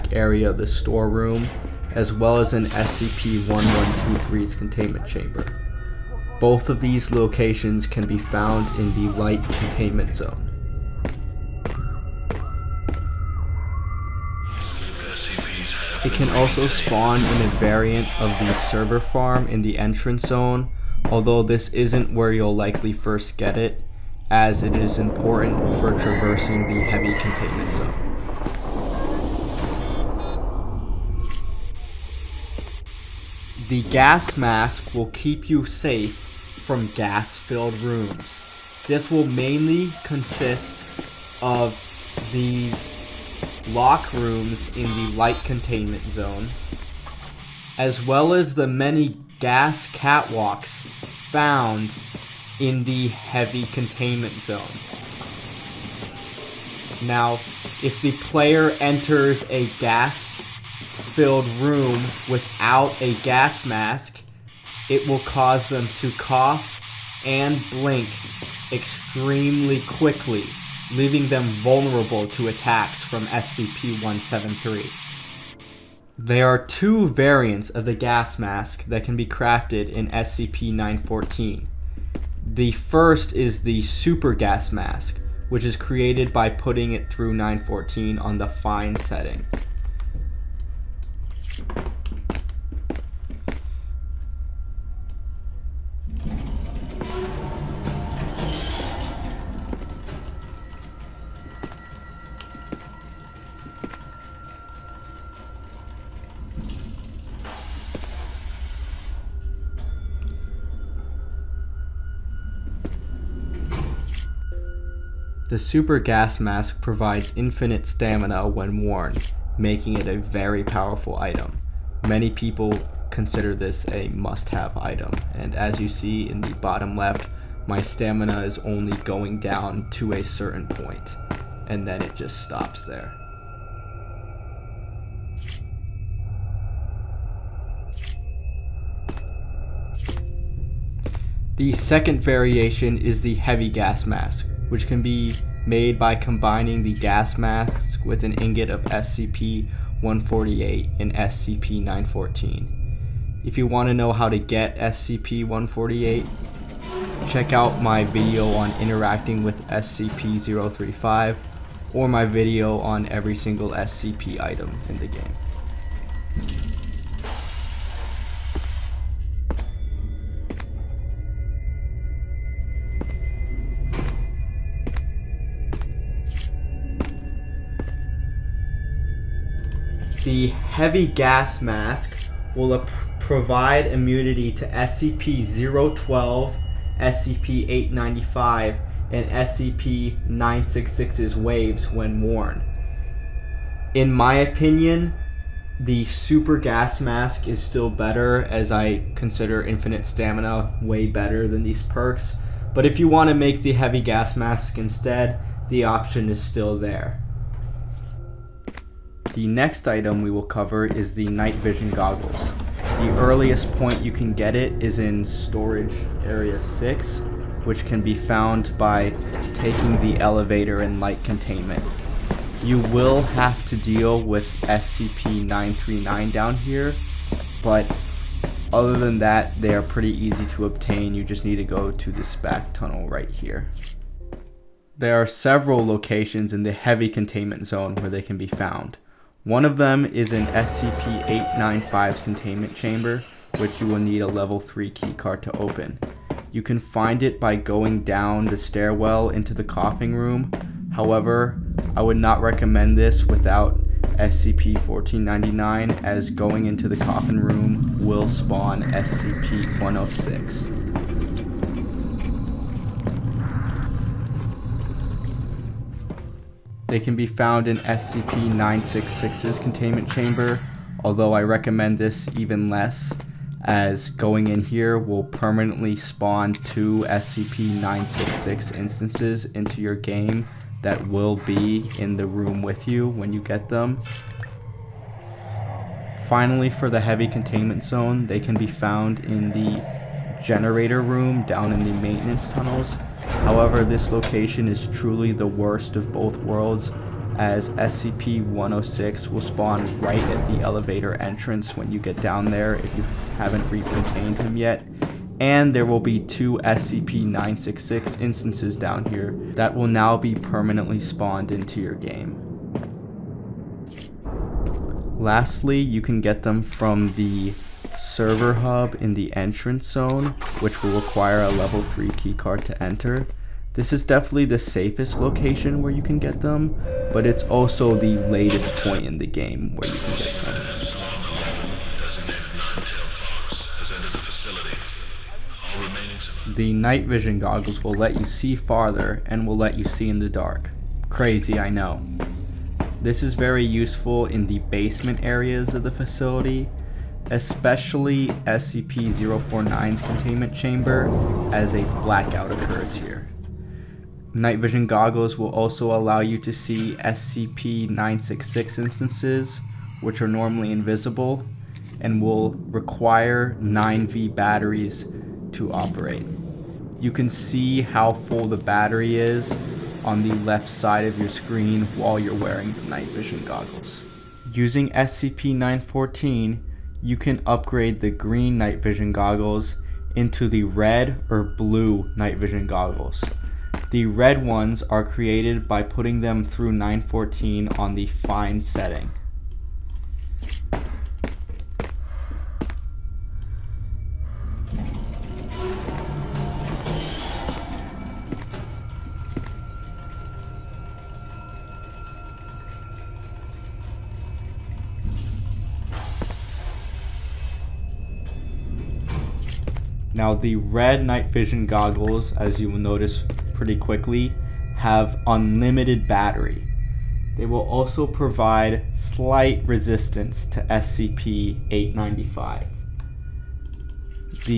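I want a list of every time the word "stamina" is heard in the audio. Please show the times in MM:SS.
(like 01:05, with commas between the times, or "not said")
01:57, 02:07, 03:20.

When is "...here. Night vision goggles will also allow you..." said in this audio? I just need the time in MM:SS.
05:52.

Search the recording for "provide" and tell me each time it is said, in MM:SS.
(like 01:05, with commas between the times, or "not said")
01:56, 03:03, 06:58.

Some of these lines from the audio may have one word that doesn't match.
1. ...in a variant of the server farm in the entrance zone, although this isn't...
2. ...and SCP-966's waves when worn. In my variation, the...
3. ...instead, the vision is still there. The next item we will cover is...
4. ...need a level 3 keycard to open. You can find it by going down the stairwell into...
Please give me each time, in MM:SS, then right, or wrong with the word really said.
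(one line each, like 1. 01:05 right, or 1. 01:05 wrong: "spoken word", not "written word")
1. 00:17 right
2. 03:09 wrong: "opinion", not "variation"
3. 03:24 wrong: "option", not "vision"
4. 04:03 right.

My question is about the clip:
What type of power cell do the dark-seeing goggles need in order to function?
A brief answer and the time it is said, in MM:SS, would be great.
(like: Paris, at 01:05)
9V batteries, at 06:03.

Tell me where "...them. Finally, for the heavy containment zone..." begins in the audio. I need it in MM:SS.
04:43.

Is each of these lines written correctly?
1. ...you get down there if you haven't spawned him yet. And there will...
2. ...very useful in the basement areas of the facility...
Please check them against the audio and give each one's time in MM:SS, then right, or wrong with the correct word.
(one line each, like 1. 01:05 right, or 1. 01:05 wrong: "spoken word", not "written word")
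1. 05:01 wrong: "recontained", not "spawned"
2. 05:43 right.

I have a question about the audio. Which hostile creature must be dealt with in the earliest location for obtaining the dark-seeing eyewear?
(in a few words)
SCP-939.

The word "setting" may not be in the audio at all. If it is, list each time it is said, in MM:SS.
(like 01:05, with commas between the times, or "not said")
01:28, 06:28.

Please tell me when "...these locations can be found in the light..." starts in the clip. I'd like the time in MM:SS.
00:06.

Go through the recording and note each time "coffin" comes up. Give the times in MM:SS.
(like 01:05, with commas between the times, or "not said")
04:09, 04:16.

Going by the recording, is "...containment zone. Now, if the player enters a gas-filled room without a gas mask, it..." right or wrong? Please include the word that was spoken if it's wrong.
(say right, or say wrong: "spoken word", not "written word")
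right.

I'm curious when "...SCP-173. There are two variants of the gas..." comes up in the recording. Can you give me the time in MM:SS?
01:13.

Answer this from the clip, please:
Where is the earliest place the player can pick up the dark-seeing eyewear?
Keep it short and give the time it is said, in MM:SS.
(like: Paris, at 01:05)
Storage area 6, at 03:35.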